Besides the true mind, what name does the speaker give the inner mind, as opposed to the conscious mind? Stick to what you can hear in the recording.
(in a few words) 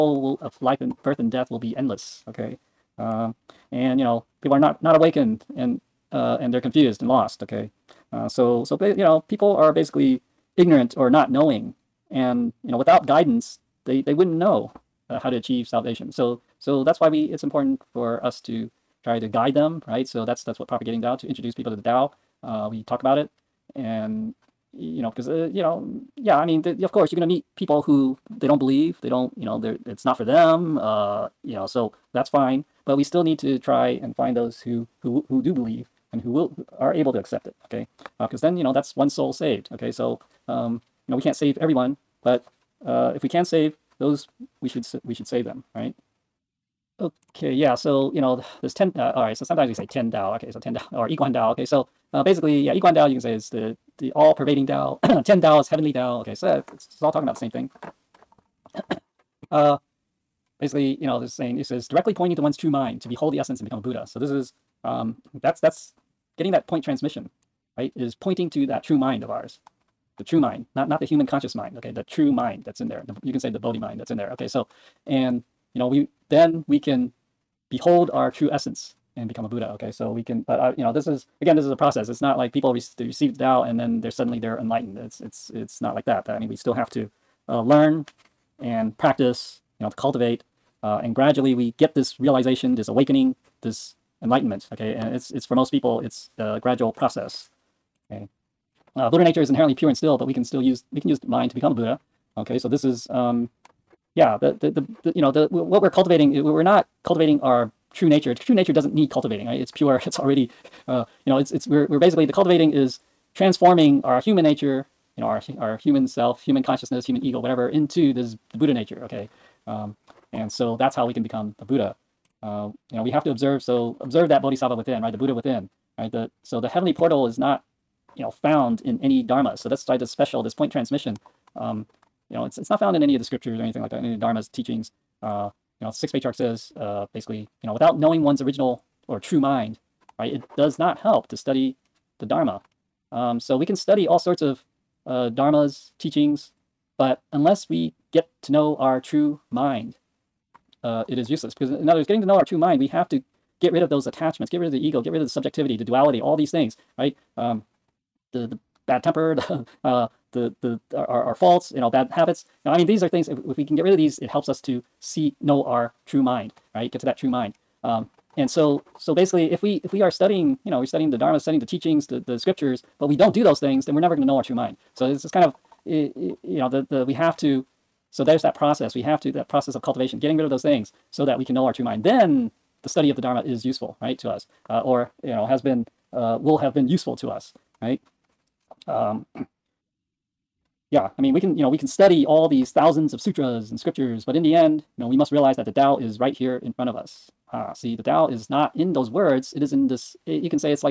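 Bodhi mind.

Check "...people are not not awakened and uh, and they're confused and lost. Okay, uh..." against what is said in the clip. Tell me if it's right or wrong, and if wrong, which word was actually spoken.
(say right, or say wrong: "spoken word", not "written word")
right.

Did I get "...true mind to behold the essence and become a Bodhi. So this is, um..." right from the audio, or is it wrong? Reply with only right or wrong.
wrong.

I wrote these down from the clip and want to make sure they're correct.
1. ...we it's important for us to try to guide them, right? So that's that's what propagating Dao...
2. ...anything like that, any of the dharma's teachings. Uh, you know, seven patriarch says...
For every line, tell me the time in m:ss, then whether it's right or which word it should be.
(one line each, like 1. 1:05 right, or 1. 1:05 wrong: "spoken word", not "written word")
1. 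0:17 right
2. 2:13 wrong: "six", not "seven".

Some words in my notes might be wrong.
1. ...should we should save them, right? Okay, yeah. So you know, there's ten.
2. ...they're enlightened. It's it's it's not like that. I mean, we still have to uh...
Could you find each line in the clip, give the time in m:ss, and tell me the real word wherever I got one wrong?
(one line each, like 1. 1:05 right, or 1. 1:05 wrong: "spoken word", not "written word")
1. 0:44 right
2. 1:24 right.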